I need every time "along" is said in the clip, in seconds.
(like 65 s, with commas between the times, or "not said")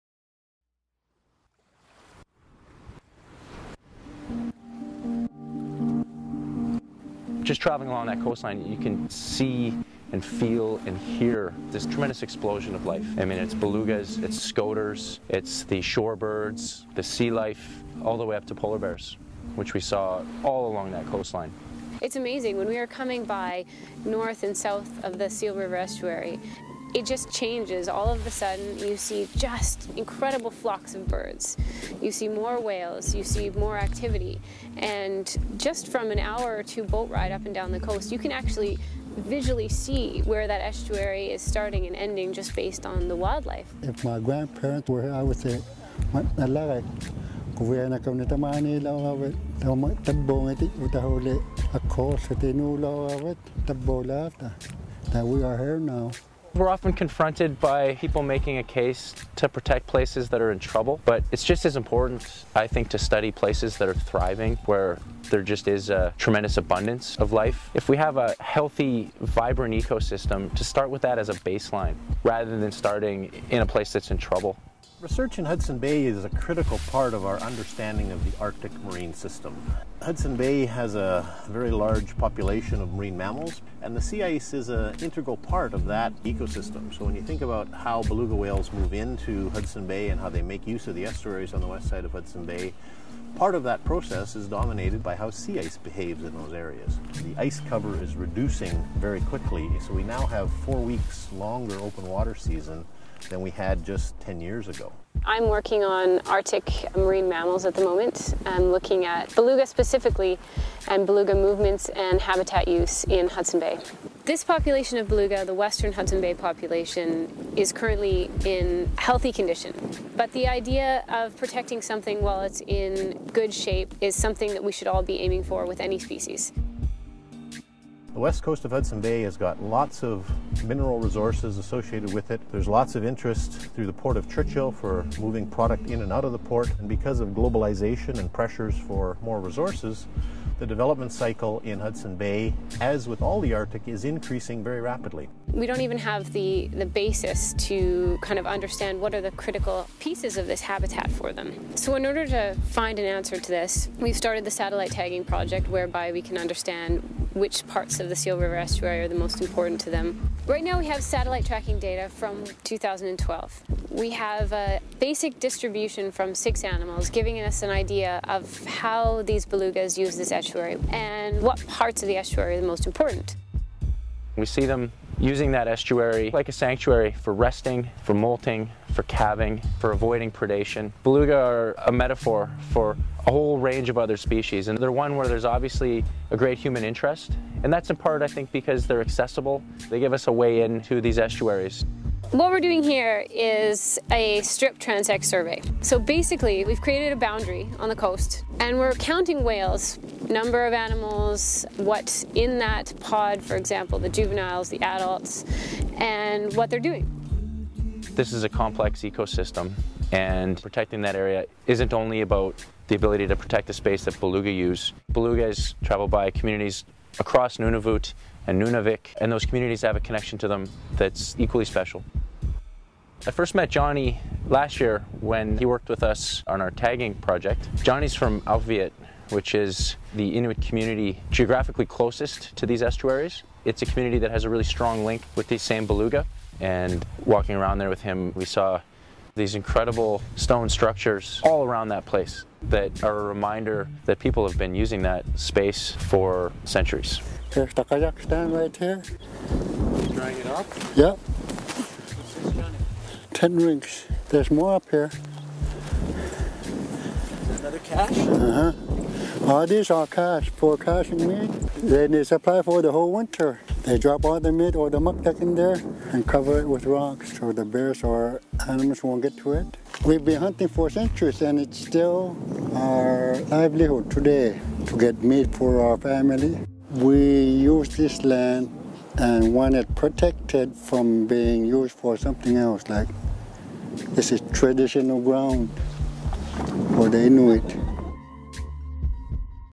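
7 s, 20 s.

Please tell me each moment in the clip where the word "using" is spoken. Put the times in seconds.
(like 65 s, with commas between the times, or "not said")
175 s, 244 s.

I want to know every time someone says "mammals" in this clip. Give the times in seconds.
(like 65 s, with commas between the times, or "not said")
83 s, 107 s.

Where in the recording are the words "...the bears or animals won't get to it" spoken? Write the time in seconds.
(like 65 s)
267 s.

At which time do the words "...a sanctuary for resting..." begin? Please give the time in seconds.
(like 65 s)
176 s.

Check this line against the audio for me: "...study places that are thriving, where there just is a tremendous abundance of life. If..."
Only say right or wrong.
right.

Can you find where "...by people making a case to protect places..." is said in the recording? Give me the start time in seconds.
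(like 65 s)
57 s.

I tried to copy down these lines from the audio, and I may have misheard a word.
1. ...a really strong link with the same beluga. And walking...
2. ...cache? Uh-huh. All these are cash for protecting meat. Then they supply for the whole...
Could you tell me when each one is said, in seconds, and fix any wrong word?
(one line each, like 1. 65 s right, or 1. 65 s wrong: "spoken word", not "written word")
1. 234 s right
2. 257 s wrong: "caching", not "protecting".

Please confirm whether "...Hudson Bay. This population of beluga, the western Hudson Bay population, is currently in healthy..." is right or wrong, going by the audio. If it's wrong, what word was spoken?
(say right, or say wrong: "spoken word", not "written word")
right.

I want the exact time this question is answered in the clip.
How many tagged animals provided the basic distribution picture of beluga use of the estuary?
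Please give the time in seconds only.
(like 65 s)
166 s.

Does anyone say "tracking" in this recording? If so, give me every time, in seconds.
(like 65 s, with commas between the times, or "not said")
161 s.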